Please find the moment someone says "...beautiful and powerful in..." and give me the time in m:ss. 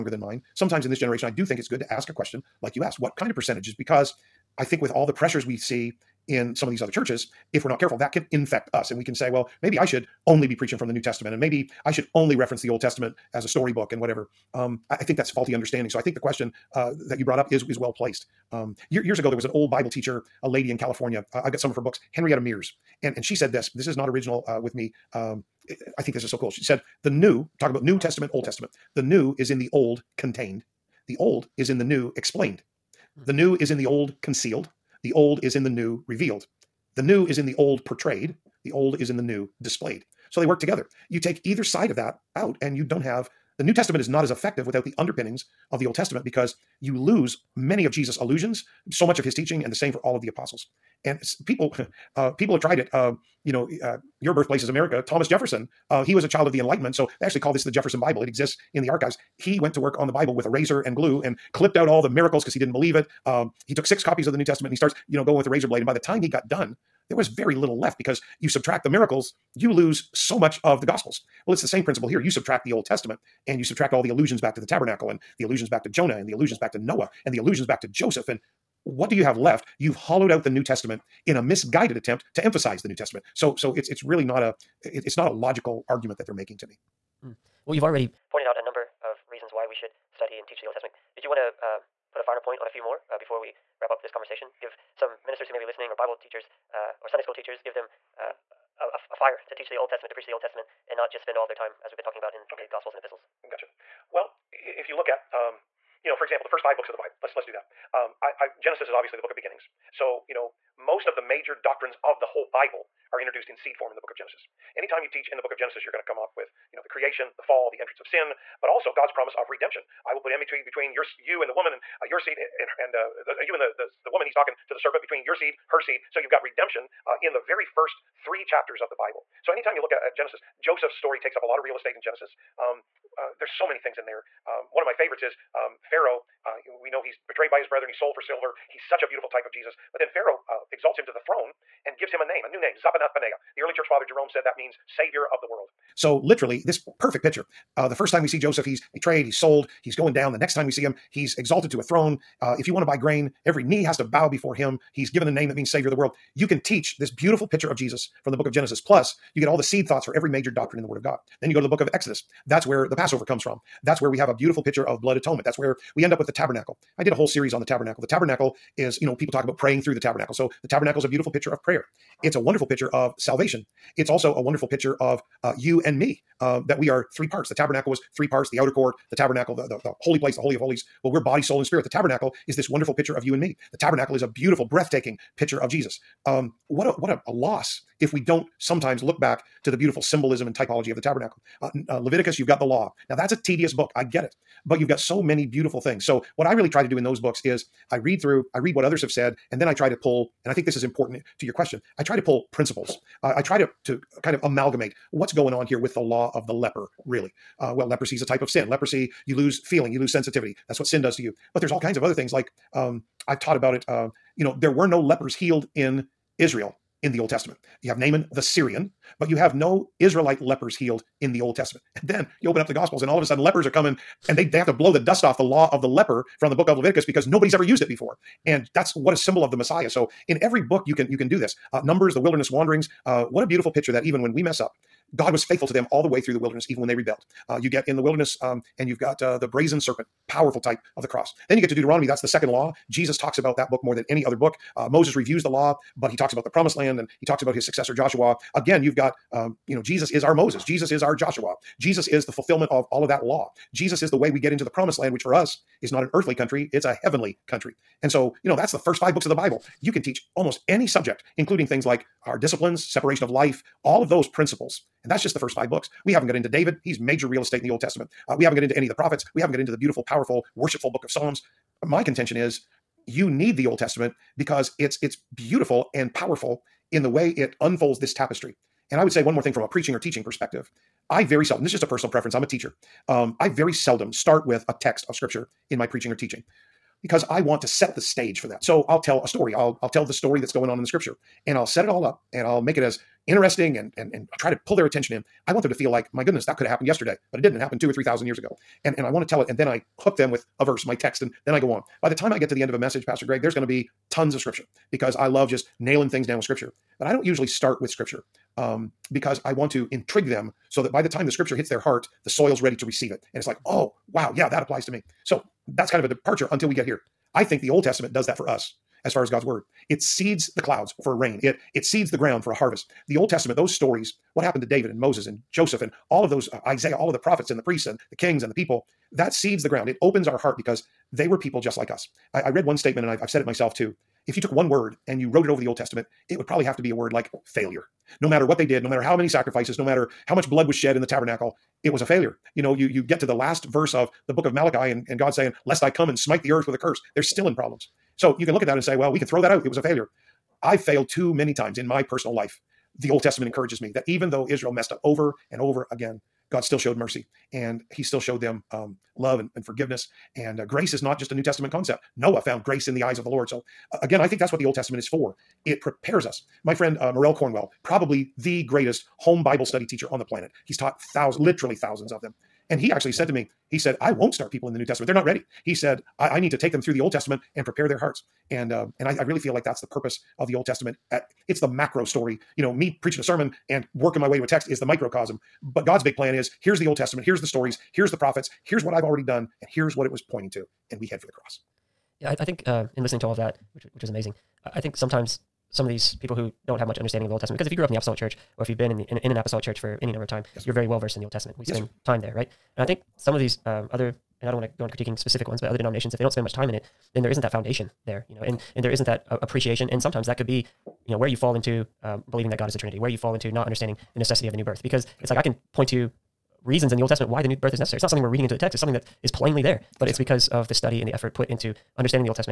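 4:35.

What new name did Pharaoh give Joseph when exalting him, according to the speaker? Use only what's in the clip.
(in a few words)
Zaphenath Paneah.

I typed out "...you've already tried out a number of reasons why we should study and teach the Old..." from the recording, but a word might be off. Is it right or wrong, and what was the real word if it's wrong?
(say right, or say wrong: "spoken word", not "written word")
wrong: "pointed", not "tried".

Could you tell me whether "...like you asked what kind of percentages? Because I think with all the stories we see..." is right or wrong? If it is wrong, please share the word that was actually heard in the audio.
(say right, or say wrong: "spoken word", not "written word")
wrong: "pressures", not "stories".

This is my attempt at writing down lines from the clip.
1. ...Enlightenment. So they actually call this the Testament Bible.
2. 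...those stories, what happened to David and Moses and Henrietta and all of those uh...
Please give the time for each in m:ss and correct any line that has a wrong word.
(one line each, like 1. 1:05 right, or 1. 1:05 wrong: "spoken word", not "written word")
1. 0:56 wrong: "Jefferson", not "Testament"
2. 5:23 wrong: "Joseph", not "Henrietta".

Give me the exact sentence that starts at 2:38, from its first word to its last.
Plus, you get all the seed thoughts for every major doctrine in the Word of God.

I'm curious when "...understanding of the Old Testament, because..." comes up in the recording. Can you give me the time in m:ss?
6:36.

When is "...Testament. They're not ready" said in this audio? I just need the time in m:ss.
6:14.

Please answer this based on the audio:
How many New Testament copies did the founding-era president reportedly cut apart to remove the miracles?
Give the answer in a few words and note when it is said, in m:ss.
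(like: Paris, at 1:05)
6, at 1:03.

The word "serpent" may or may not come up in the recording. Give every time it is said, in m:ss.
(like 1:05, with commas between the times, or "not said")
2:04, 3:59.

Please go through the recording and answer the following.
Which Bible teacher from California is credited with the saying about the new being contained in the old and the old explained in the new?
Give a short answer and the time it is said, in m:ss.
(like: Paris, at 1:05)
Henrietta Mears, at 0:22.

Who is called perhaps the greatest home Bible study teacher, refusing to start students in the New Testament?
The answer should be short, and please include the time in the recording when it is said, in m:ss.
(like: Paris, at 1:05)
Morel Cornwell, at 6:07.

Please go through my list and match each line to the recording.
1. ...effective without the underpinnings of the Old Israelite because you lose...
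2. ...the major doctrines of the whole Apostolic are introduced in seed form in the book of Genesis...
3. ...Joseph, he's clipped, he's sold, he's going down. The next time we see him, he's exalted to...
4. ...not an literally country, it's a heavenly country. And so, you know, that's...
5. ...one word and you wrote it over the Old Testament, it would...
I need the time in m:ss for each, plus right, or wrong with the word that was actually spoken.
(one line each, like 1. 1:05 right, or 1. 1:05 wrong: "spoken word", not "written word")
1. 0:44 wrong: "Testament", not "Israelite"
2. 1:51 wrong: "Bible", not "Apostolic"
3. 2:28 wrong: "betrayed", not "clipped"
4. 4:15 wrong: "earthly", not "literally"
5. 5:34 right.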